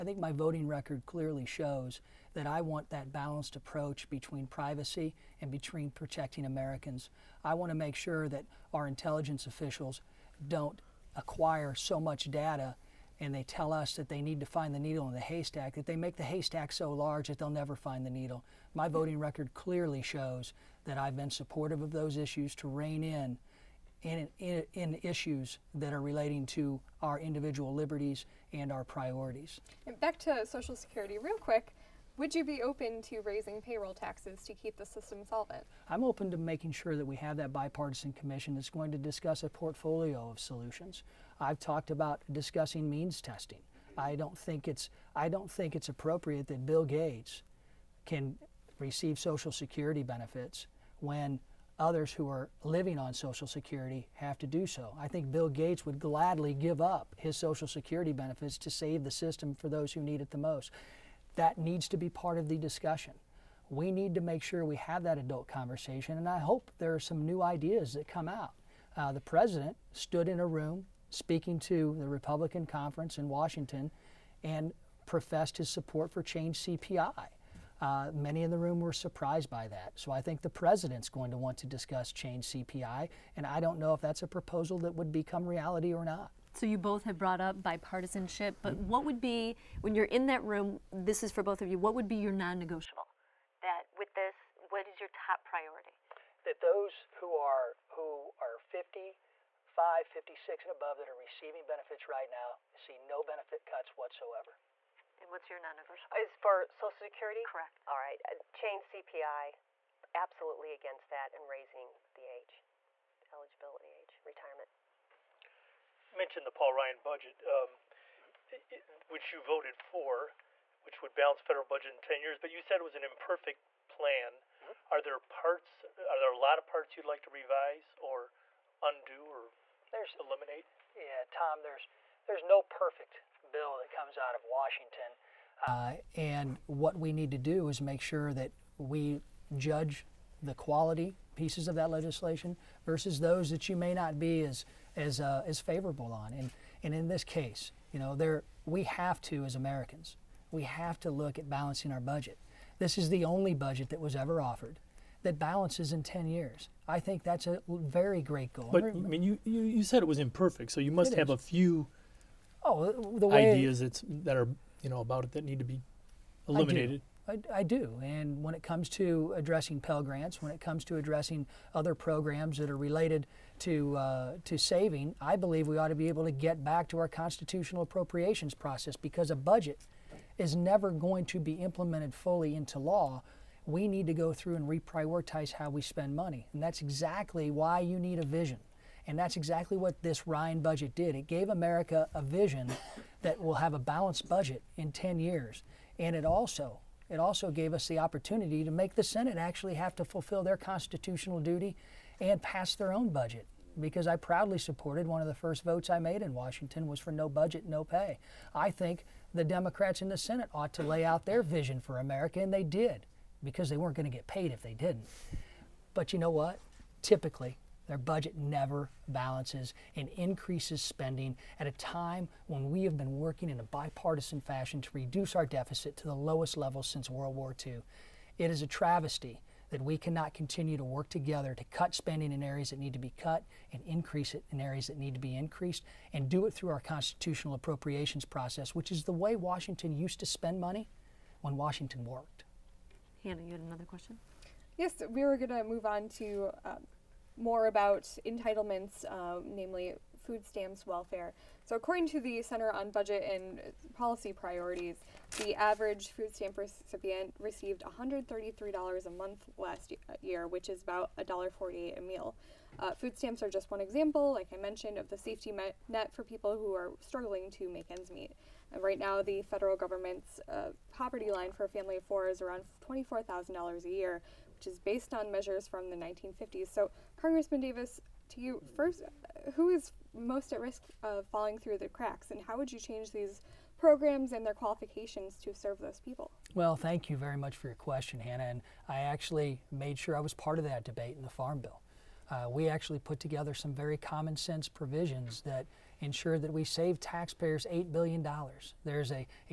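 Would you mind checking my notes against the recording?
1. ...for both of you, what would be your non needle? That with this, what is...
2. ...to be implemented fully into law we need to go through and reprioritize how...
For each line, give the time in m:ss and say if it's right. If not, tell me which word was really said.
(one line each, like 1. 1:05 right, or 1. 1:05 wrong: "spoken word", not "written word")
1. 1:31 wrong: "negotiable", not "needle"
2. 3:01 right.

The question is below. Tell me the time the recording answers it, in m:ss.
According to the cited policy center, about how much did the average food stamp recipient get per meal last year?
4:21.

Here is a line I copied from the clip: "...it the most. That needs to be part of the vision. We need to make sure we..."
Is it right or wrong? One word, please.
wrong.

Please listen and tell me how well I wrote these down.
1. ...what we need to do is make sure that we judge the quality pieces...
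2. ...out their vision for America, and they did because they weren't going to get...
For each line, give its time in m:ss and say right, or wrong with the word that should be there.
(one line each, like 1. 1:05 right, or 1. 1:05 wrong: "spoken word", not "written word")
1. 2:16 right
2. 3:31 right.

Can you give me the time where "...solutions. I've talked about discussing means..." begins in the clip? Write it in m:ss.
0:40.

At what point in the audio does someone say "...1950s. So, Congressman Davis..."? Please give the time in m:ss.
4:35.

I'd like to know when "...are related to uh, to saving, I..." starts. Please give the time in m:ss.
2:52.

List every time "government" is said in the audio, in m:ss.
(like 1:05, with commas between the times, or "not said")
4:29.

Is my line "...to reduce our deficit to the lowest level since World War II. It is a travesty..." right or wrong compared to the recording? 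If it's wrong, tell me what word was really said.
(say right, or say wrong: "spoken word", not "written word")
right.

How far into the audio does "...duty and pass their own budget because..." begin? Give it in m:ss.
3:21.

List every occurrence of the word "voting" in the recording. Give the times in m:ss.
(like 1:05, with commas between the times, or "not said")
0:00, 0:18.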